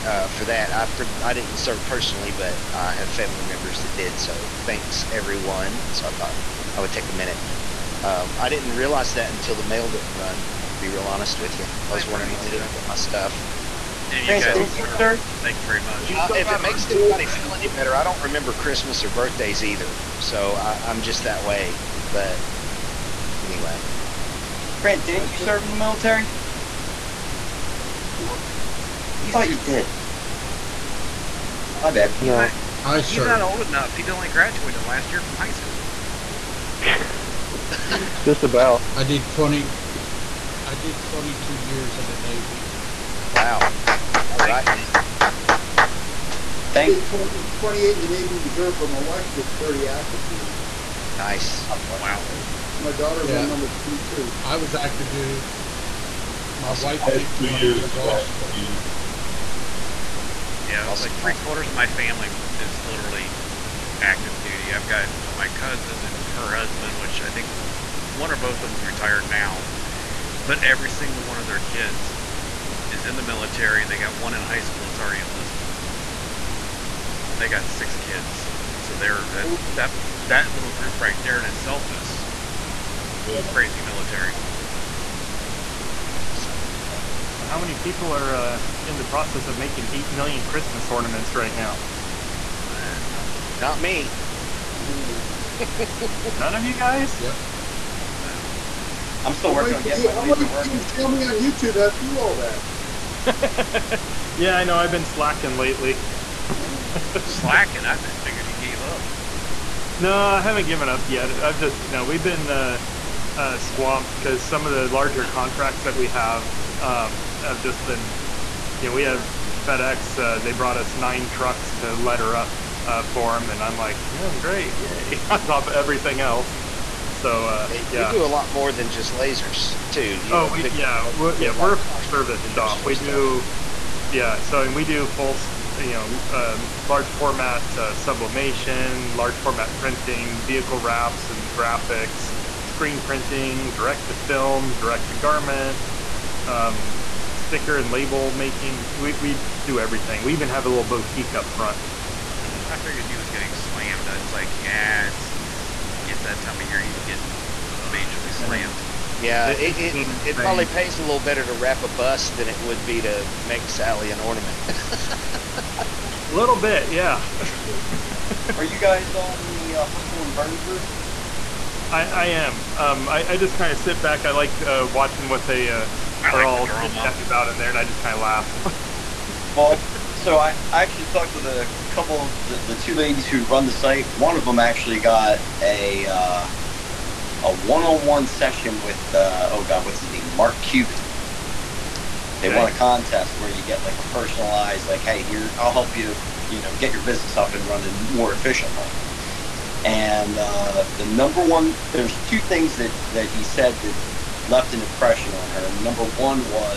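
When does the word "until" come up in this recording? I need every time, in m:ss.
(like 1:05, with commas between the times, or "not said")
0:09.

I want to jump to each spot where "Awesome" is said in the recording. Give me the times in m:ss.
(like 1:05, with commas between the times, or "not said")
0:56, 1:01.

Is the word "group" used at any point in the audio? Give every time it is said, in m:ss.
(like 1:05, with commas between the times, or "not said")
1:20, 2:50.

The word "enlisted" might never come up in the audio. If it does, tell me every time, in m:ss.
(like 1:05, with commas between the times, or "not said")
1:15.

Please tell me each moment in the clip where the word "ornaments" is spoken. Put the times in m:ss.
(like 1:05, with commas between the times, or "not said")
1:30, 2:44.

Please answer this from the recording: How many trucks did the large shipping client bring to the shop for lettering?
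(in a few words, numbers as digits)
9.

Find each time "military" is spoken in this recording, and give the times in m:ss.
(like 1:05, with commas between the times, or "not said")
0:25, 1:13, 1:23.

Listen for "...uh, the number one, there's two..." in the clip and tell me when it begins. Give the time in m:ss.
3:20.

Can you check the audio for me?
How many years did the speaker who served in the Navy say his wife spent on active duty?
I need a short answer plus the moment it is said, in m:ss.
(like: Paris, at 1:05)
30, at 0:49.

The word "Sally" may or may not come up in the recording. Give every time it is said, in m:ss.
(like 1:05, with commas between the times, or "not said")
2:43.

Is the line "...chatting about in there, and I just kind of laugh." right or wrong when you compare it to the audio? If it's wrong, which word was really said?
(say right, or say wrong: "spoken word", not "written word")
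right.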